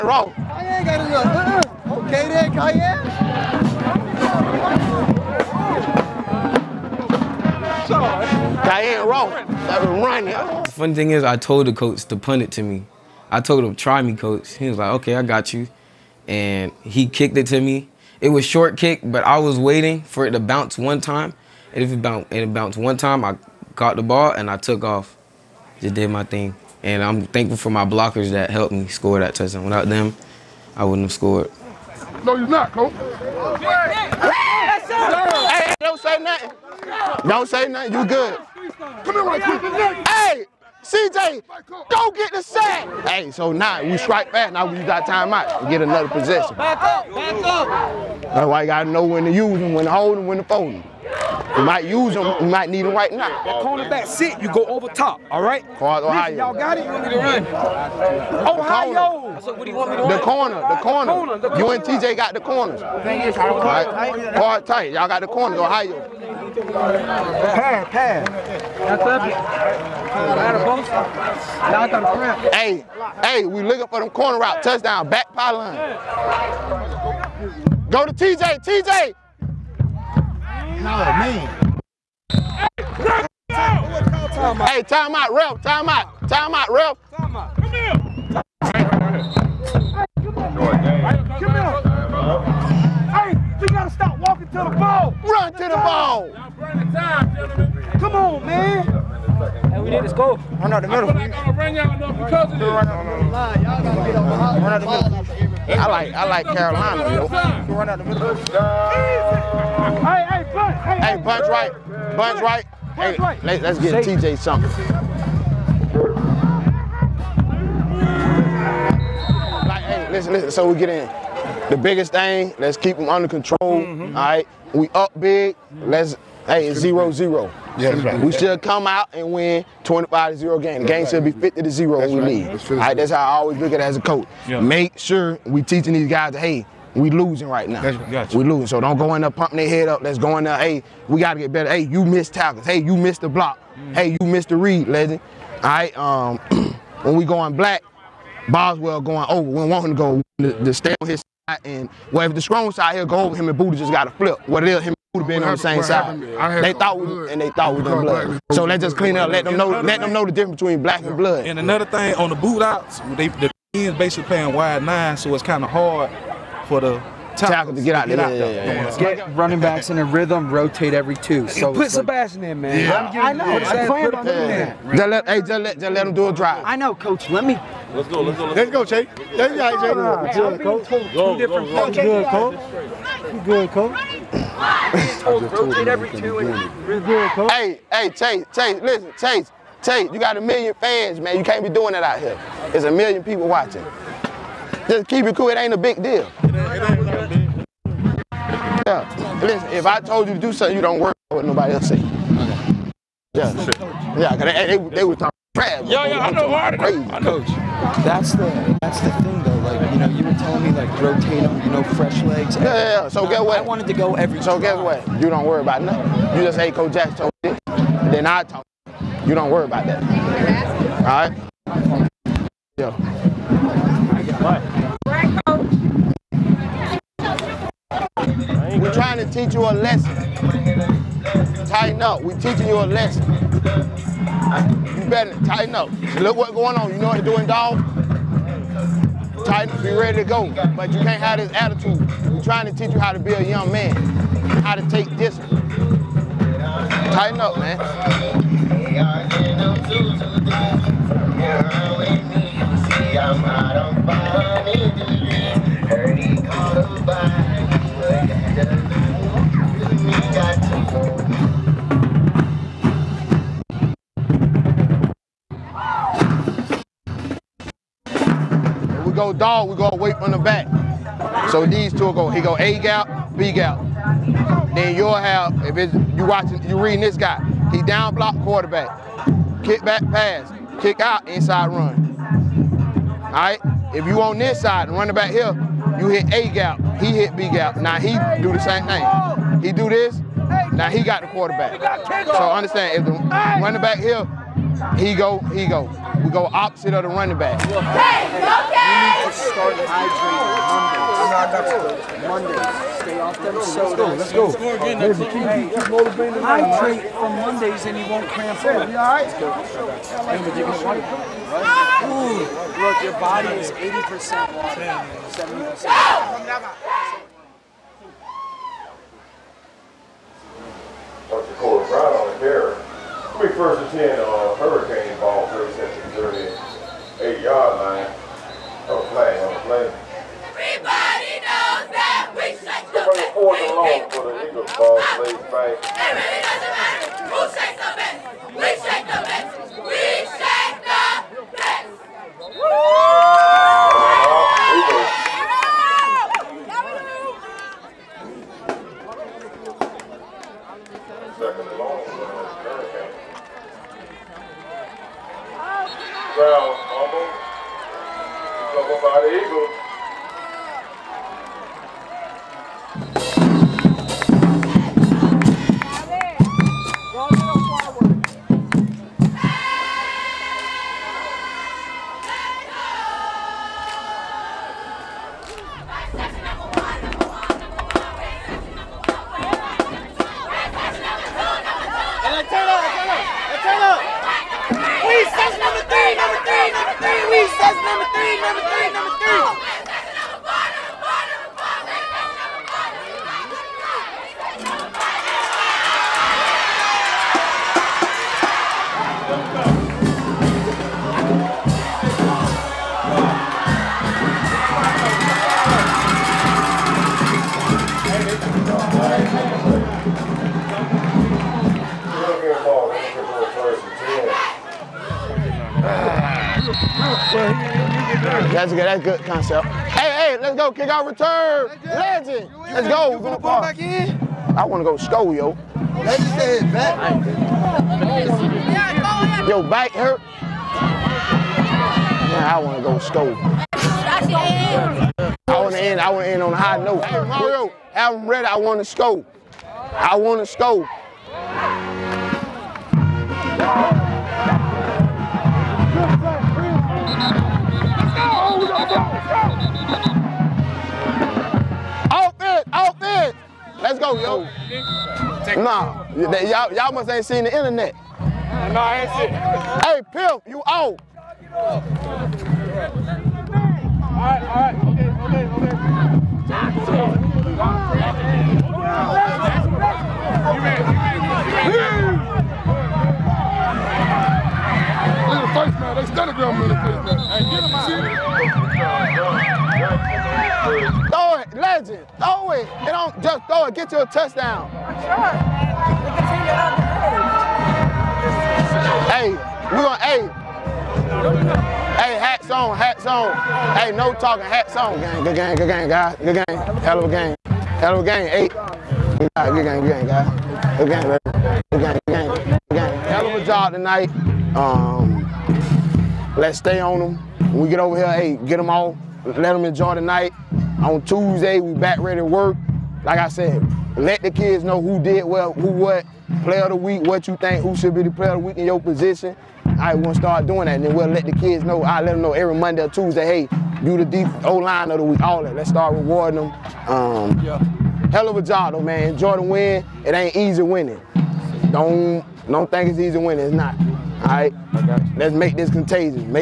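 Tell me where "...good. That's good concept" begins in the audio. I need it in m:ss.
6:58.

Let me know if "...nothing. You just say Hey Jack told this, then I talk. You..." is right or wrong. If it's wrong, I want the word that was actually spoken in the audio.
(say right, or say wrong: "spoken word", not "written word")
wrong: "Coach", not "Hey".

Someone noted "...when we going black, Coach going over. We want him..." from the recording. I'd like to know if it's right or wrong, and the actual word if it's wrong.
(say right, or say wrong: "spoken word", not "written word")
wrong: "Boswell", not "Coach".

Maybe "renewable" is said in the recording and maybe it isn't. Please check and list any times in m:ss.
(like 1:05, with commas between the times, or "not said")
not said.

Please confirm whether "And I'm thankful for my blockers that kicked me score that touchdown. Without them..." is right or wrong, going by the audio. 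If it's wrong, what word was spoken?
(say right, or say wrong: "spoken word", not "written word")
wrong: "helped", not "kicked".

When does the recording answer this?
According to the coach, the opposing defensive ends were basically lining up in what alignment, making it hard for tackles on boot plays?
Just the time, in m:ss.
2:44.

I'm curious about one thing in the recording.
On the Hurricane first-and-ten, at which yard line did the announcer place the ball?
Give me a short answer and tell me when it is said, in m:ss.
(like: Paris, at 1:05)
38, at 5:27.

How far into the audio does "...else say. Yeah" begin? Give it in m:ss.
3:21.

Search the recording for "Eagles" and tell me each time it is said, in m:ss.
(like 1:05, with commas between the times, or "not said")
5:34, 5:59.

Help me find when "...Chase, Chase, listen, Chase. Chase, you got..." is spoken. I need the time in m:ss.
3:08.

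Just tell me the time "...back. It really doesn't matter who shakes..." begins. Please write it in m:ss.
5:35.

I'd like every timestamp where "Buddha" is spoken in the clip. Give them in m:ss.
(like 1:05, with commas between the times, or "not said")
2:33.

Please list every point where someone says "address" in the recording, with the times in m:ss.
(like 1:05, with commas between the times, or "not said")
not said.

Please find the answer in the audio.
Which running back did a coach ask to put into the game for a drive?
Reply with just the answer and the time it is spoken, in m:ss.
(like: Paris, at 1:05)
Sebastian, at 2:51.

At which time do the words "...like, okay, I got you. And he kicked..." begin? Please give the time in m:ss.
0:14.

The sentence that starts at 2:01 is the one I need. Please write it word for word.
The biggest thing, let's keep them under control.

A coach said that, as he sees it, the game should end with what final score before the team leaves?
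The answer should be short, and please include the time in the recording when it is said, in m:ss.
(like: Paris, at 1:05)
50 to 0, at 2:11.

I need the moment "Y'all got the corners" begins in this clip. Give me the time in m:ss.
1:04.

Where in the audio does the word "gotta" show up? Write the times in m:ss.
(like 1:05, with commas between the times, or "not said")
1:33, 2:21, 2:33.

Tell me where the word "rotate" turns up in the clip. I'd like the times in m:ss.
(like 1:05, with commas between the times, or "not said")
2:50, 3:05, 3:30.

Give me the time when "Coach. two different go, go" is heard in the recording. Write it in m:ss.
3:00.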